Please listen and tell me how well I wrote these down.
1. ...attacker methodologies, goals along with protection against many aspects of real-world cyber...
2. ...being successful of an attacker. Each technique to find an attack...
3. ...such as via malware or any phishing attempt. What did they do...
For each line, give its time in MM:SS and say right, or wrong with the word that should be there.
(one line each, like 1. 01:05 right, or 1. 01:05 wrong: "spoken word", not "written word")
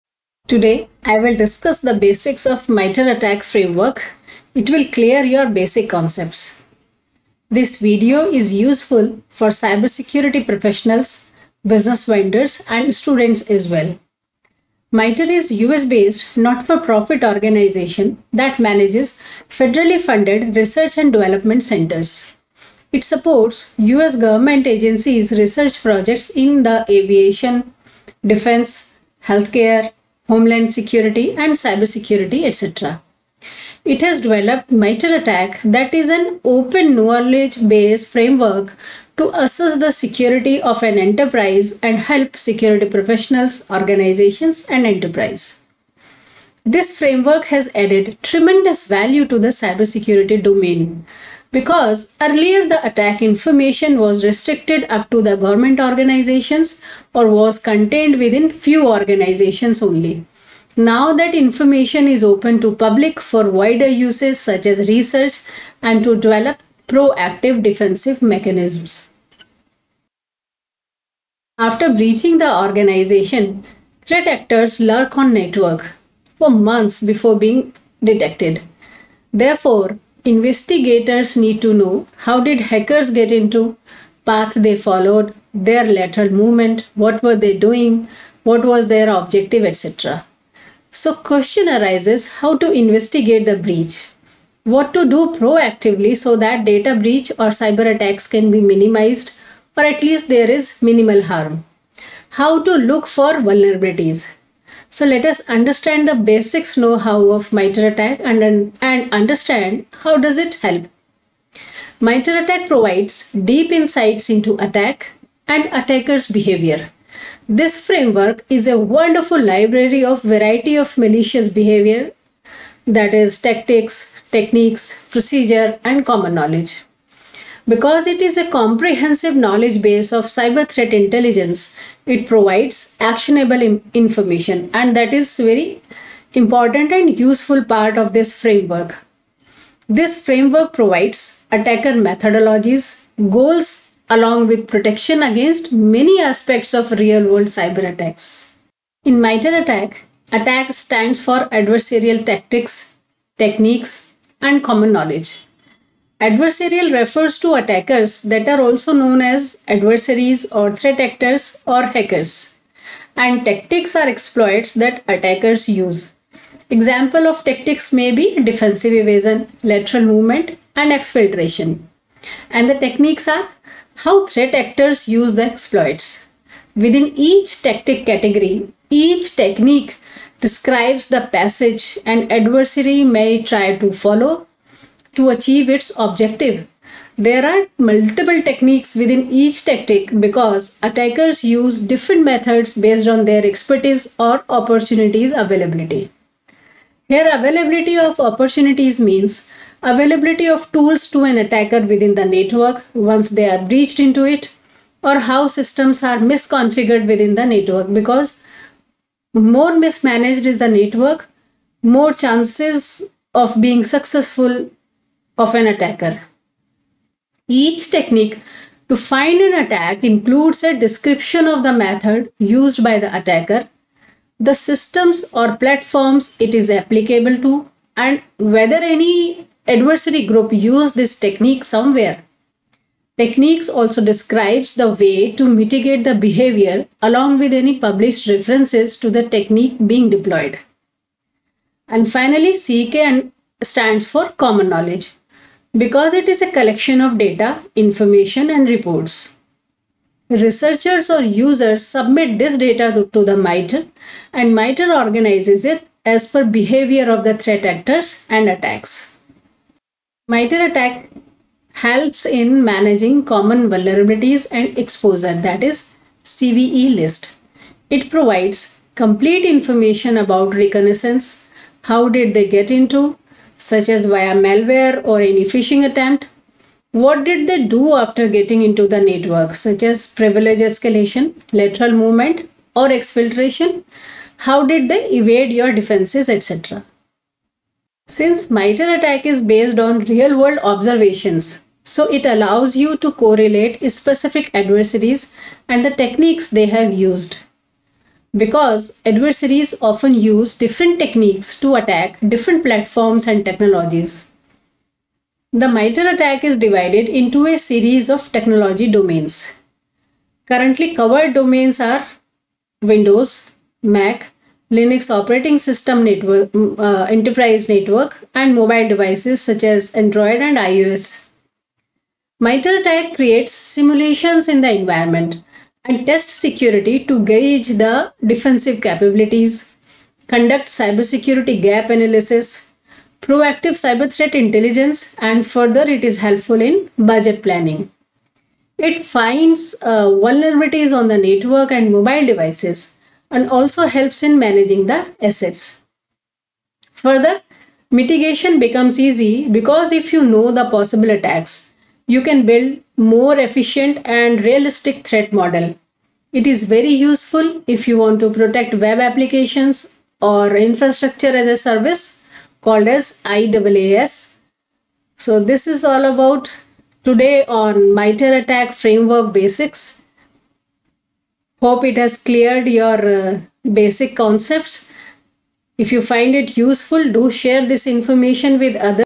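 1. 02:21 right
2. 03:33 right
3. 04:33 right.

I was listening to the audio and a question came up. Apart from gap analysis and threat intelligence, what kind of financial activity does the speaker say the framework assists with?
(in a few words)
budget planning.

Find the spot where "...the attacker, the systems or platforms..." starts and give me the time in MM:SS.
03:42.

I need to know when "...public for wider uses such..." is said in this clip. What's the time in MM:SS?
01:02.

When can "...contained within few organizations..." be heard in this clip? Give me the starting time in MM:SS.
00:57.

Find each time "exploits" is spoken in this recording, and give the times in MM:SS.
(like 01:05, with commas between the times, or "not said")
02:44, 02:55.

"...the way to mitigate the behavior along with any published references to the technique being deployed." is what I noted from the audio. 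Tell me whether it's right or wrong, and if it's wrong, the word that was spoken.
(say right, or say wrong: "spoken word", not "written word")
right.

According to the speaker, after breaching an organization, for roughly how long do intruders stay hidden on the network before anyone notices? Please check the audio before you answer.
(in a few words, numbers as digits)
months.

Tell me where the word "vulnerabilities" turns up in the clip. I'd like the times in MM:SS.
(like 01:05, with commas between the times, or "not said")
01:43, 04:23, 05:40.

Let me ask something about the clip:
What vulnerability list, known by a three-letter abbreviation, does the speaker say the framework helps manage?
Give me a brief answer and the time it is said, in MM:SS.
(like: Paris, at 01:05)
CVE list, at 04:26.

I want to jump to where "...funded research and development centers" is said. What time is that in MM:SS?
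00:20.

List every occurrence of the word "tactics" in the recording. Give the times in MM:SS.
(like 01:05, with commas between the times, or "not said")
02:03, 02:32, 02:43, 02:47, 02:57, 03:09.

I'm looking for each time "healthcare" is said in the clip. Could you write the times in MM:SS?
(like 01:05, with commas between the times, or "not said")
00:29.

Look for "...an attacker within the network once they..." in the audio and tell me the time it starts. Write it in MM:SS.
03:21.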